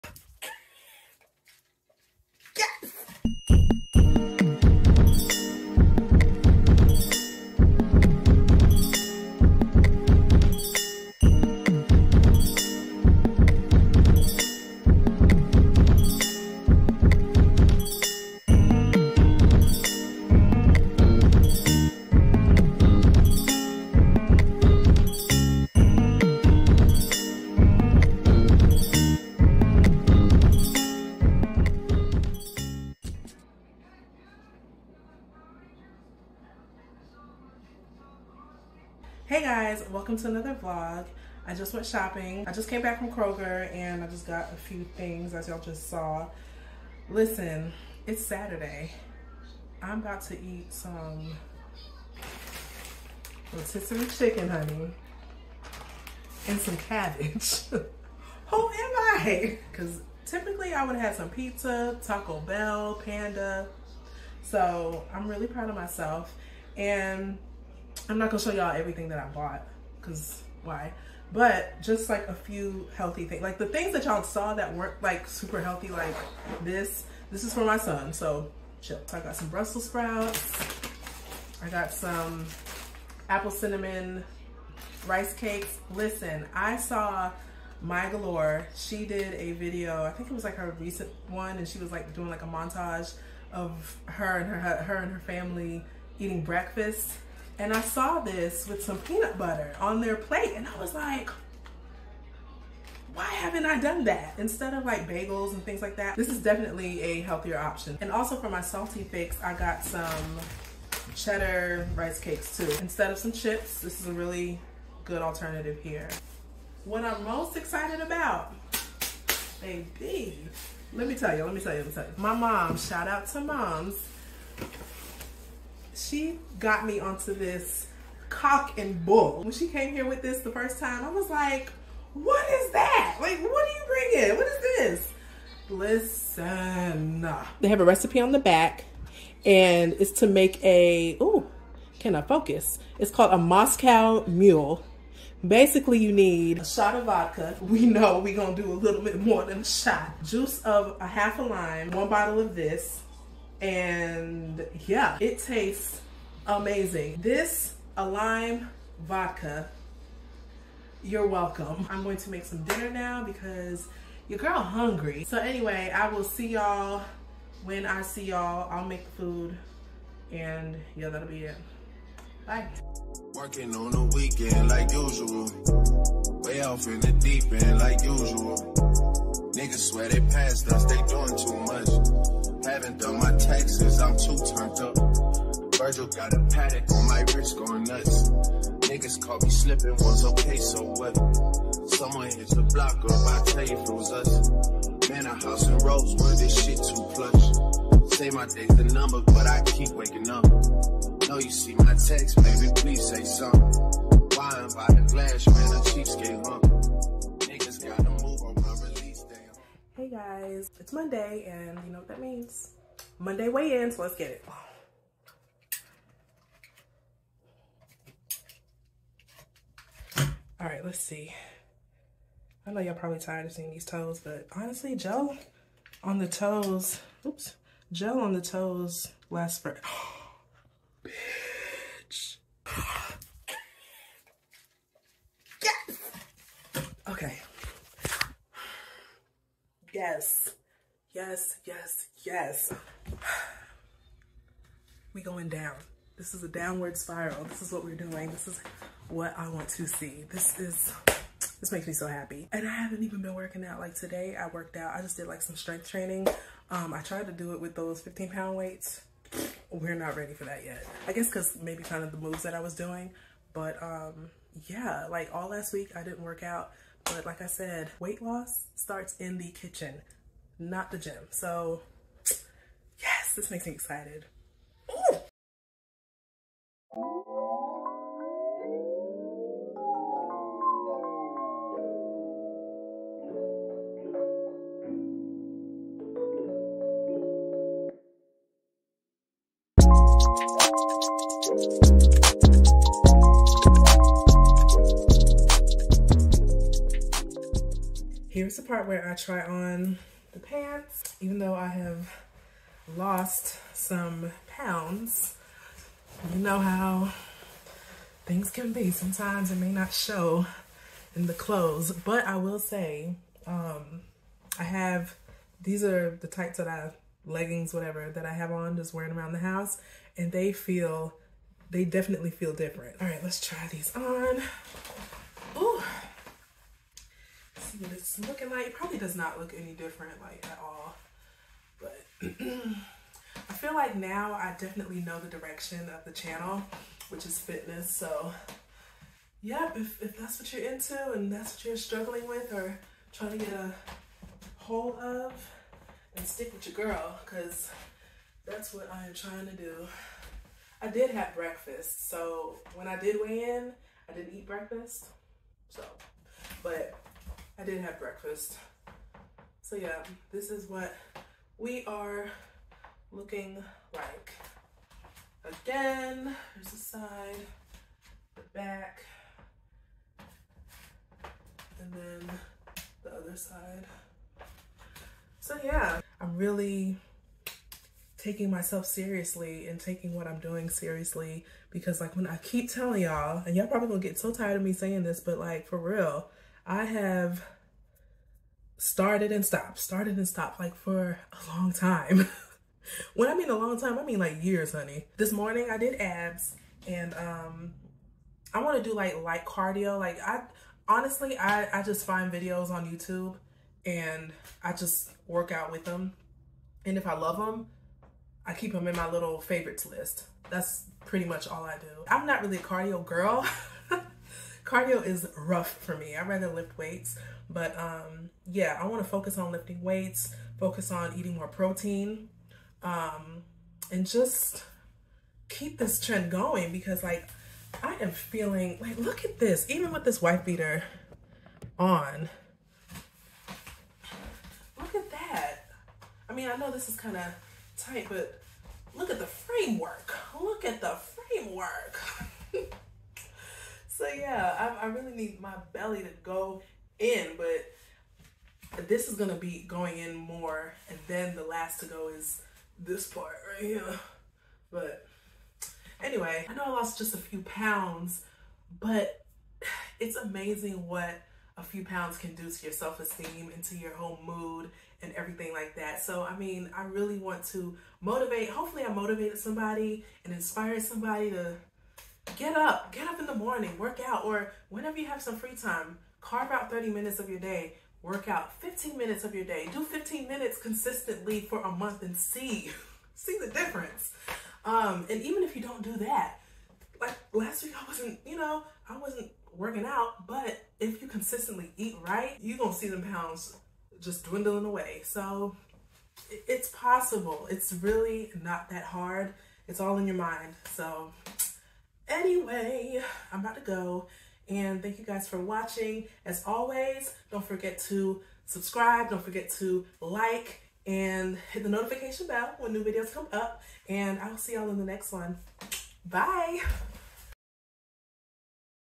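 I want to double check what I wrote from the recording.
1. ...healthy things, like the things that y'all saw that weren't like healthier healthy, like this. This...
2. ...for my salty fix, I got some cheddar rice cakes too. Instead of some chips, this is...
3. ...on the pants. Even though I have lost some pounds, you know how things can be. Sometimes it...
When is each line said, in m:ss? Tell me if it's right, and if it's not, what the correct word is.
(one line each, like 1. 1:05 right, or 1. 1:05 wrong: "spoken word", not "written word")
1. 1:12 wrong: "super", not "healthier"
2. 1:48 right
3. 4:59 right.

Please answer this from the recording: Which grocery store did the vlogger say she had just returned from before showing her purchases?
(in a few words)
Kroger.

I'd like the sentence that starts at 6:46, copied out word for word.
And if I love them, I keep them in my little favorites list.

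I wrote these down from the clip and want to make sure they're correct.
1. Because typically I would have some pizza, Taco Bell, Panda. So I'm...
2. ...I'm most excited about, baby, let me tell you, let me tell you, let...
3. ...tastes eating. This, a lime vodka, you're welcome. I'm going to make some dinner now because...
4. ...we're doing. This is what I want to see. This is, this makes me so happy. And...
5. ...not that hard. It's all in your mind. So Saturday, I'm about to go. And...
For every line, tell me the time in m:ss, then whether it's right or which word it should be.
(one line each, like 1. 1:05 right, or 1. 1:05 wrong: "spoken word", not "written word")
1. 0:59 right
2. 1:57 right
3. 2:35 wrong: "amazing", not "eating"
4. 4:07 right
5. 8:18 wrong: "Anyway", not "Saturday".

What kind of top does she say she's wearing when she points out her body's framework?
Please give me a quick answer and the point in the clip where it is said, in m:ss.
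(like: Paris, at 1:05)
White beater, at 7:10.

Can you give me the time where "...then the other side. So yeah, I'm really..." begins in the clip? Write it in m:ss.
6:11.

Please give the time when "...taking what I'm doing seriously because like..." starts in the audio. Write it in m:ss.
6:19.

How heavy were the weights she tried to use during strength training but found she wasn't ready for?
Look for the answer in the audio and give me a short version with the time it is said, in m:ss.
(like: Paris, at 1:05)
15 pounds, at 4:17.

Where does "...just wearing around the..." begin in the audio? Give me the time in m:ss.
5:18.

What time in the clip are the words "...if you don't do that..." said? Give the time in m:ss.
8:05.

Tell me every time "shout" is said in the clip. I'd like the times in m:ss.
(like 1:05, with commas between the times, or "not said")
2:02.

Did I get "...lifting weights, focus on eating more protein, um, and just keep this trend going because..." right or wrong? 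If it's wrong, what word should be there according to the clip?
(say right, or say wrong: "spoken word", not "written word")
right.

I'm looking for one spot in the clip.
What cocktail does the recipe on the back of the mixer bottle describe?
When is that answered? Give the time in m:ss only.
2:23.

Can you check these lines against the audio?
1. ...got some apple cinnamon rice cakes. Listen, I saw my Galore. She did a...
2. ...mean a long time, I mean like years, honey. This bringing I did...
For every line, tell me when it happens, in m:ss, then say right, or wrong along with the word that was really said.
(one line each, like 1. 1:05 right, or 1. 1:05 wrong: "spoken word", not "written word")
1. 1:21 right
2. 6:33 wrong: "morning", not "bringing".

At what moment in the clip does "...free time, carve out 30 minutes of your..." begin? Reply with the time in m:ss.
7:55.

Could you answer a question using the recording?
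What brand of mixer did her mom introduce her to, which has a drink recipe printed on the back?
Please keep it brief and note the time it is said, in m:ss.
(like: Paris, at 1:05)
Cock and bull, at 2:08.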